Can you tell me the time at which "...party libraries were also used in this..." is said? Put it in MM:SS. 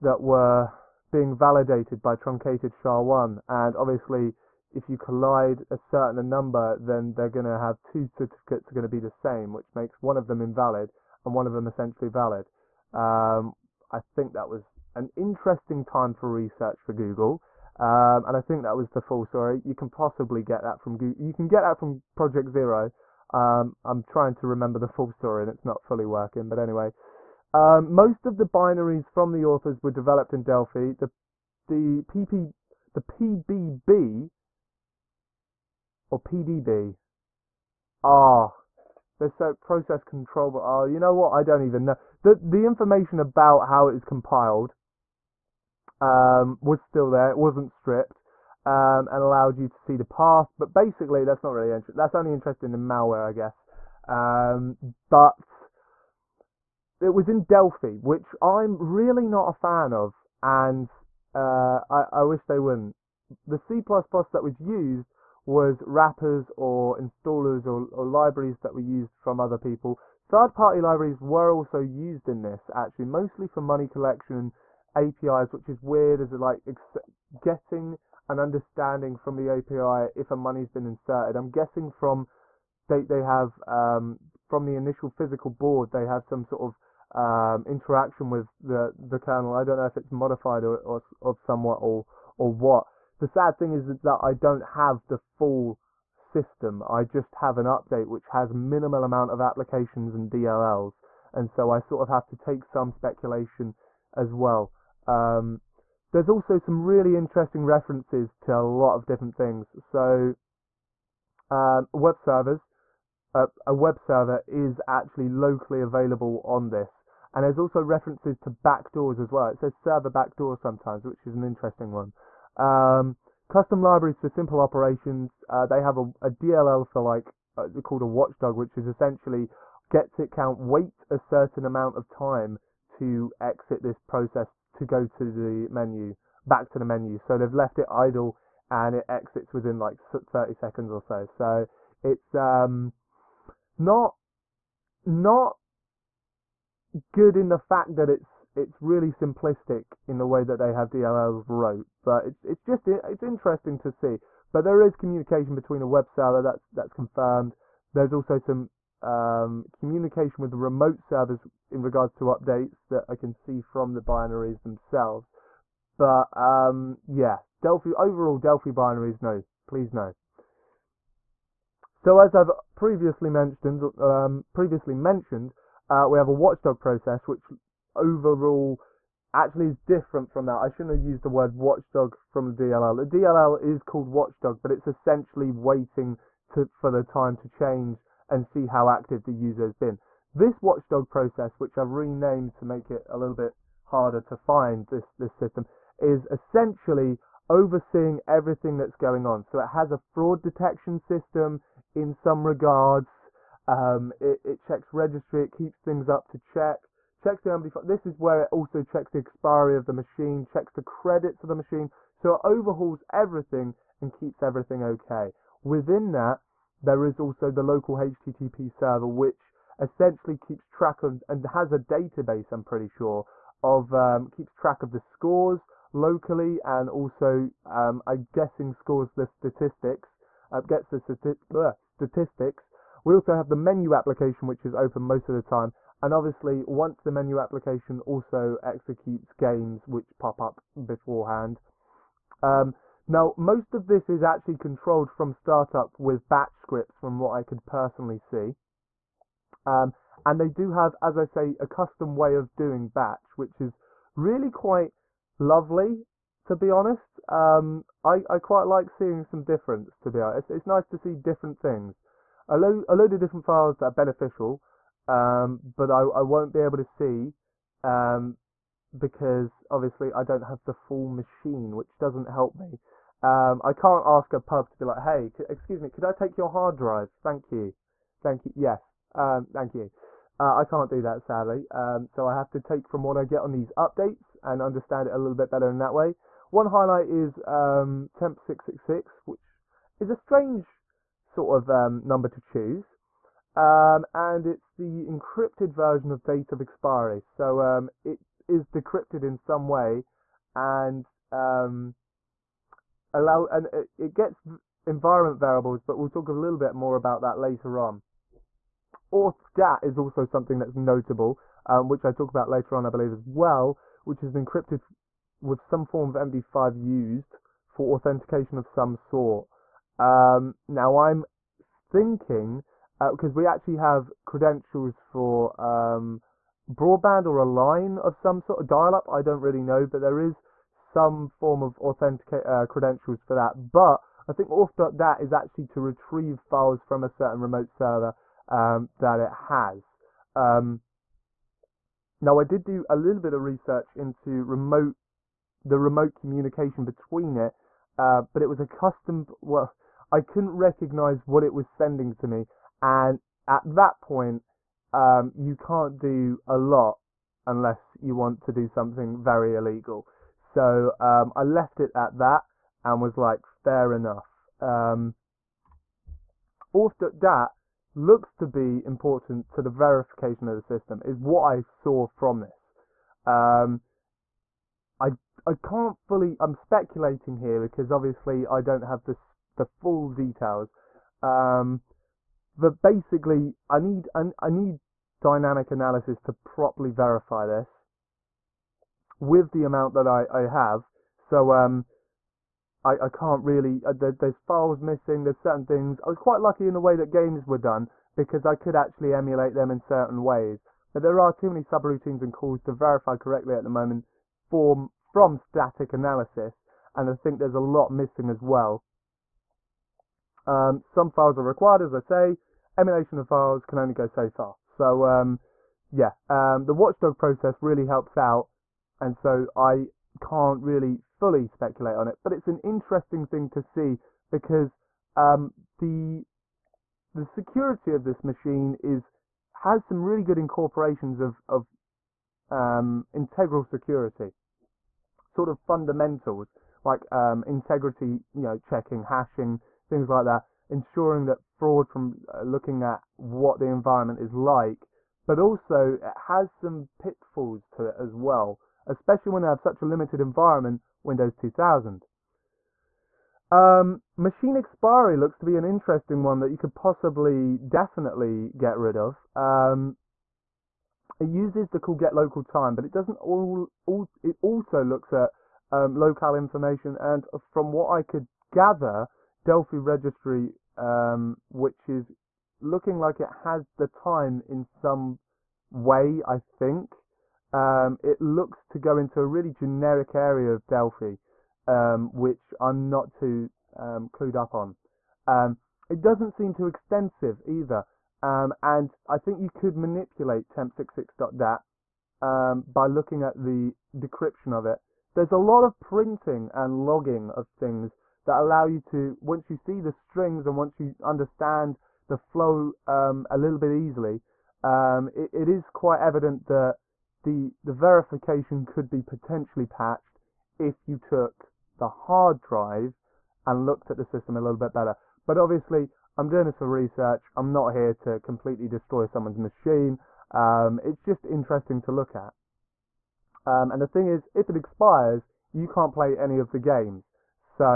01:10.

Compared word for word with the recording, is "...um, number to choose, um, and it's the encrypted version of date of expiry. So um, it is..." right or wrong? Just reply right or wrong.
right.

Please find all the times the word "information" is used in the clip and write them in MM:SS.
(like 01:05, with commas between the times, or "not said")
00:42, 07:46.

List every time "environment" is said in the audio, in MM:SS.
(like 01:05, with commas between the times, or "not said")
05:04, 07:23, 07:30.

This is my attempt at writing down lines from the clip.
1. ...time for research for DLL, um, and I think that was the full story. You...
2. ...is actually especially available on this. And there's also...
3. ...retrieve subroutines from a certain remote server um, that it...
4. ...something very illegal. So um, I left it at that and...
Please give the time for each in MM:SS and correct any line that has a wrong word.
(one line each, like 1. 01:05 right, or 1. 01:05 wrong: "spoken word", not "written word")
1. 00:15 wrong: "Google", not "DLL"
2. 01:54 wrong: "locally", not "especially"
3. 05:35 wrong: "files", not "subroutines"
4. 05:58 right.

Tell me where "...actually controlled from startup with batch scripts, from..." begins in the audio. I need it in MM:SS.
04:04.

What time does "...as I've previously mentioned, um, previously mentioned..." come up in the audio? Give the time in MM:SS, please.
02:52.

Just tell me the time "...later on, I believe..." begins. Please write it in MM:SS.
05:12.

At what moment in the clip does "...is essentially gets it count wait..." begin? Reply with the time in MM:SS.
02:08.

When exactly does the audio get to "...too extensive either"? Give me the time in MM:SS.
08:06.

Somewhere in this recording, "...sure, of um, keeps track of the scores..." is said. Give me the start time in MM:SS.
03:42.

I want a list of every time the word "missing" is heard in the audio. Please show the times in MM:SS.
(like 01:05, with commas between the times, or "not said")
06:34, 06:47.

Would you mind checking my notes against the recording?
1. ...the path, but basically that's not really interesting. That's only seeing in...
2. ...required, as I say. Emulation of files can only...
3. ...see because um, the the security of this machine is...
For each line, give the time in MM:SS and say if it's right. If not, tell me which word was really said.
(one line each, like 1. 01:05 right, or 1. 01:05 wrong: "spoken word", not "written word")
1. 00:49 wrong: "interesting", not "seeing"
2. 06:51 right
3. 07:03 right.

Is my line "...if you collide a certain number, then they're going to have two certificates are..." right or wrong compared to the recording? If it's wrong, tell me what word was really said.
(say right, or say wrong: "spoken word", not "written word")
right.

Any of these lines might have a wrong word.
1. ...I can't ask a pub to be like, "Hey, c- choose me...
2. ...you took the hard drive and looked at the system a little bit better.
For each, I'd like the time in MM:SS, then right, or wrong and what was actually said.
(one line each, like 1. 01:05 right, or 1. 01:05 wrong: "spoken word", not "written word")
1. 04:33 wrong: "excuse", not "choose"
2. 08:30 right.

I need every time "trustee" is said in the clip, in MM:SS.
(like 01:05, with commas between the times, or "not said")
not said.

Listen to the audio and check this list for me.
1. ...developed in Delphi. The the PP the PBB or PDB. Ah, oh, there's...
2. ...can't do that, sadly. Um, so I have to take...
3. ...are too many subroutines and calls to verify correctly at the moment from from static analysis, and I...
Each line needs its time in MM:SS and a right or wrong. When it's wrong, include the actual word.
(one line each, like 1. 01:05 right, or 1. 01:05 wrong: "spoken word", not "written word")
1. 00:29 right
2. 04:40 right
3. 06:41 right.